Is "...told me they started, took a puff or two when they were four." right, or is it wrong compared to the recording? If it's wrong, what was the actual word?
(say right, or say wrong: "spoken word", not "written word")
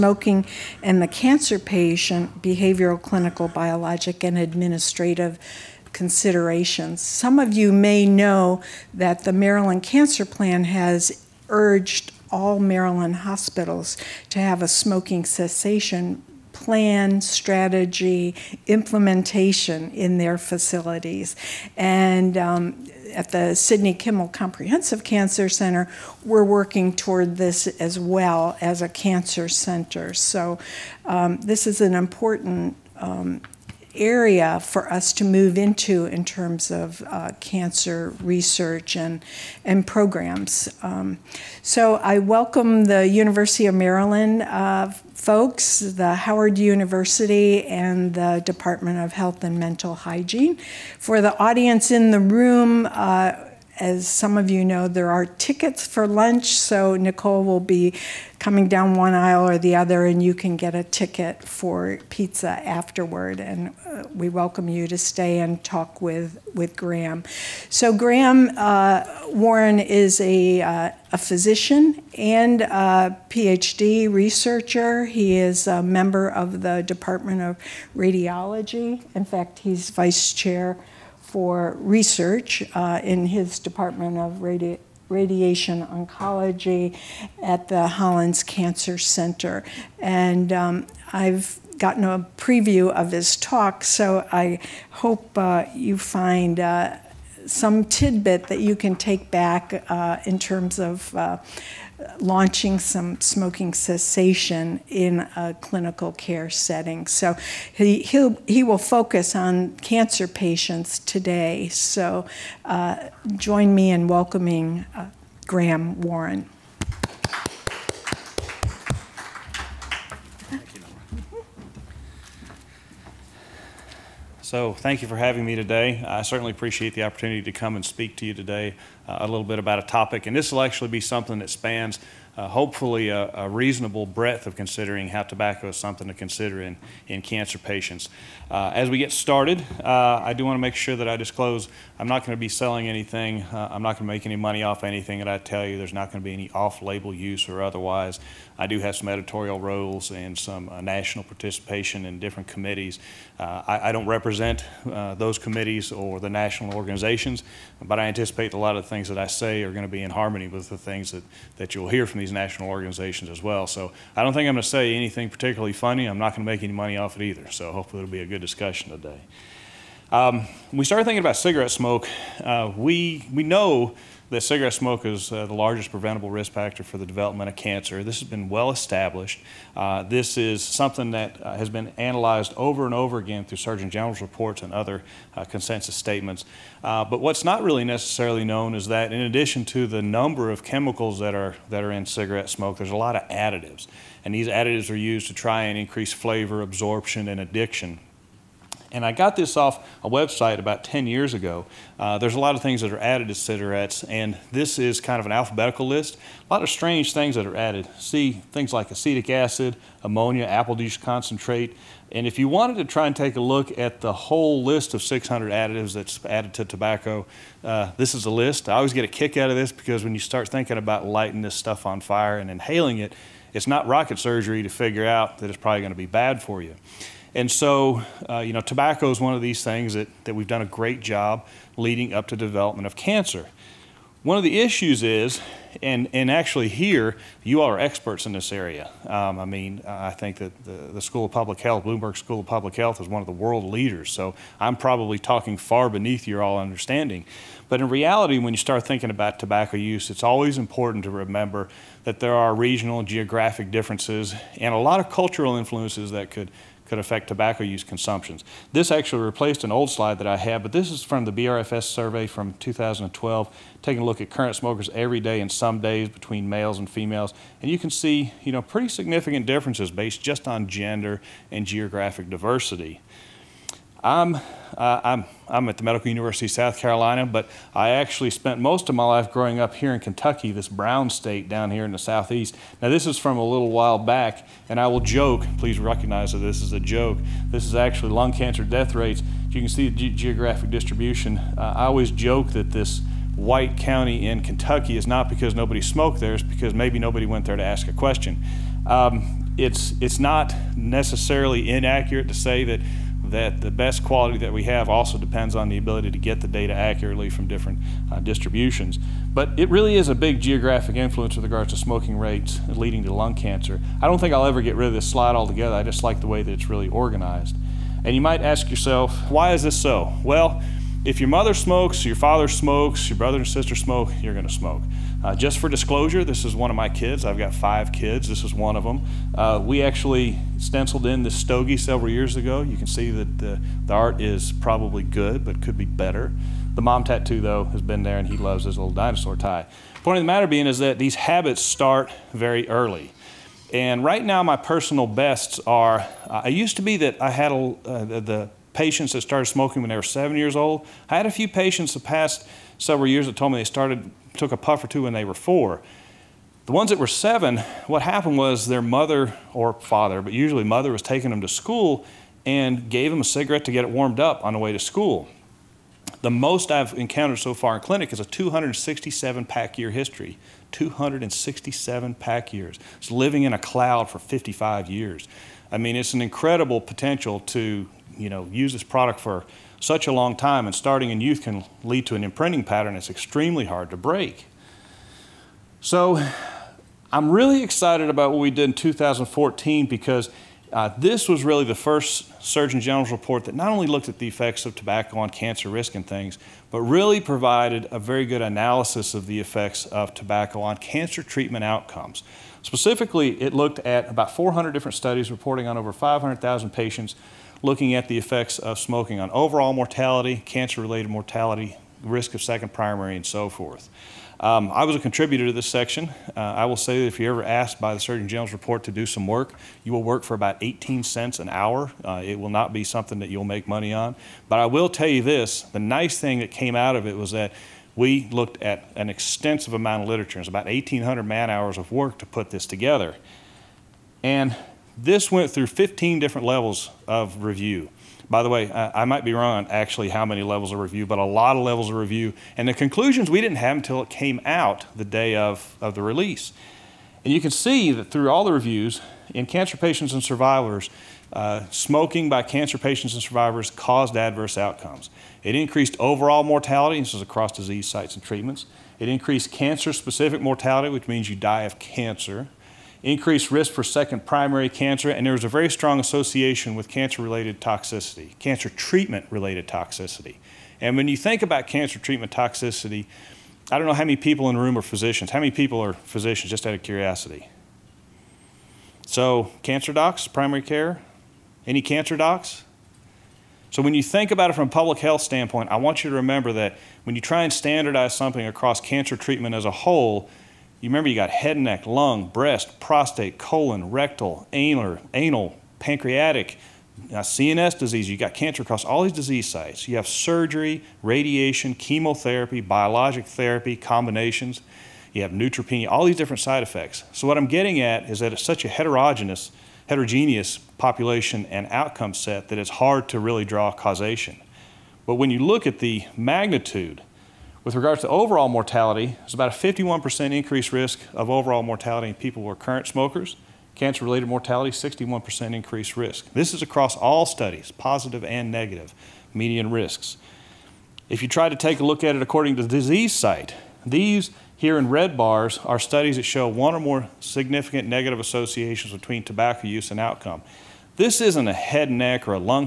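right.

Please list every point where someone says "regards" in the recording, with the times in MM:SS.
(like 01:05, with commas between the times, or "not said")
05:11, 08:37.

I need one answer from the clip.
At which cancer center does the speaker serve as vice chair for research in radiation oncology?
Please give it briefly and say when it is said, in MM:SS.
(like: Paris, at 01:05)
Hollings Cancer Center, at 01:27.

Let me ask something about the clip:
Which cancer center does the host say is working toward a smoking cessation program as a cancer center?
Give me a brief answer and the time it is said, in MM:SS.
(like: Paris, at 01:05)
Sidney Kimmel Comprehensive Cancer Center, at 00:23.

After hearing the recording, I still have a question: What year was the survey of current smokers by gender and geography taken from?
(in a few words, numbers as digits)
2012.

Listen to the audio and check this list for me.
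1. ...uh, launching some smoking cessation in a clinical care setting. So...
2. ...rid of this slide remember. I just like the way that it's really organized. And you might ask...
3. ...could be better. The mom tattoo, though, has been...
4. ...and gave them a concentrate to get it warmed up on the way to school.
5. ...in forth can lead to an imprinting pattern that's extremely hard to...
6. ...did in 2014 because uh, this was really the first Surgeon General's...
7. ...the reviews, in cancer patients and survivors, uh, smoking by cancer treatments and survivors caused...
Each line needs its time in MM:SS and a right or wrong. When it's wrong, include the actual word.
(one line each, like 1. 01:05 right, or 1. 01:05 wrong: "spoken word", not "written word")
1. 01:41 right
2. 05:14 wrong: "altogether", not "remember"
3. 05:35 right
4. 06:02 wrong: "cigarette", not "concentrate"
5. 06:21 wrong: "youth", not "forth"
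6. 06:28 right
7. 07:28 wrong: "patients", not "treatments".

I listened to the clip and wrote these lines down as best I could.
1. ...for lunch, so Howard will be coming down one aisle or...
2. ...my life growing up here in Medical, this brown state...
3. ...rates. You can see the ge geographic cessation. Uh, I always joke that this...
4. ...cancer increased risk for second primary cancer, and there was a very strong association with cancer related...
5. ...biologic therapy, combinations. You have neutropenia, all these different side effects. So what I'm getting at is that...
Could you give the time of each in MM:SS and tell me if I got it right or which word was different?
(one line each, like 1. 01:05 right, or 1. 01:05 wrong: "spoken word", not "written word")
1. 00:55 wrong: "Nicole", not "Howard"
2. 04:38 wrong: "Kentucky", not "Medical"
3. 04:48 wrong: "distribution", not "cessation"
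4. 07:41 right
5. 08:22 right.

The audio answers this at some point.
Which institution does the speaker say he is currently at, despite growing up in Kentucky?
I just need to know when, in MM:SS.
04:35.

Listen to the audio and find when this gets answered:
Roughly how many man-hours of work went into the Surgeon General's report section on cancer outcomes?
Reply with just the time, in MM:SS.
07:10.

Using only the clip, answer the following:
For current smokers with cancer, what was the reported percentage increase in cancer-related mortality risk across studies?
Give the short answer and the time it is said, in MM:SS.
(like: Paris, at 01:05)
61%, at 08:44.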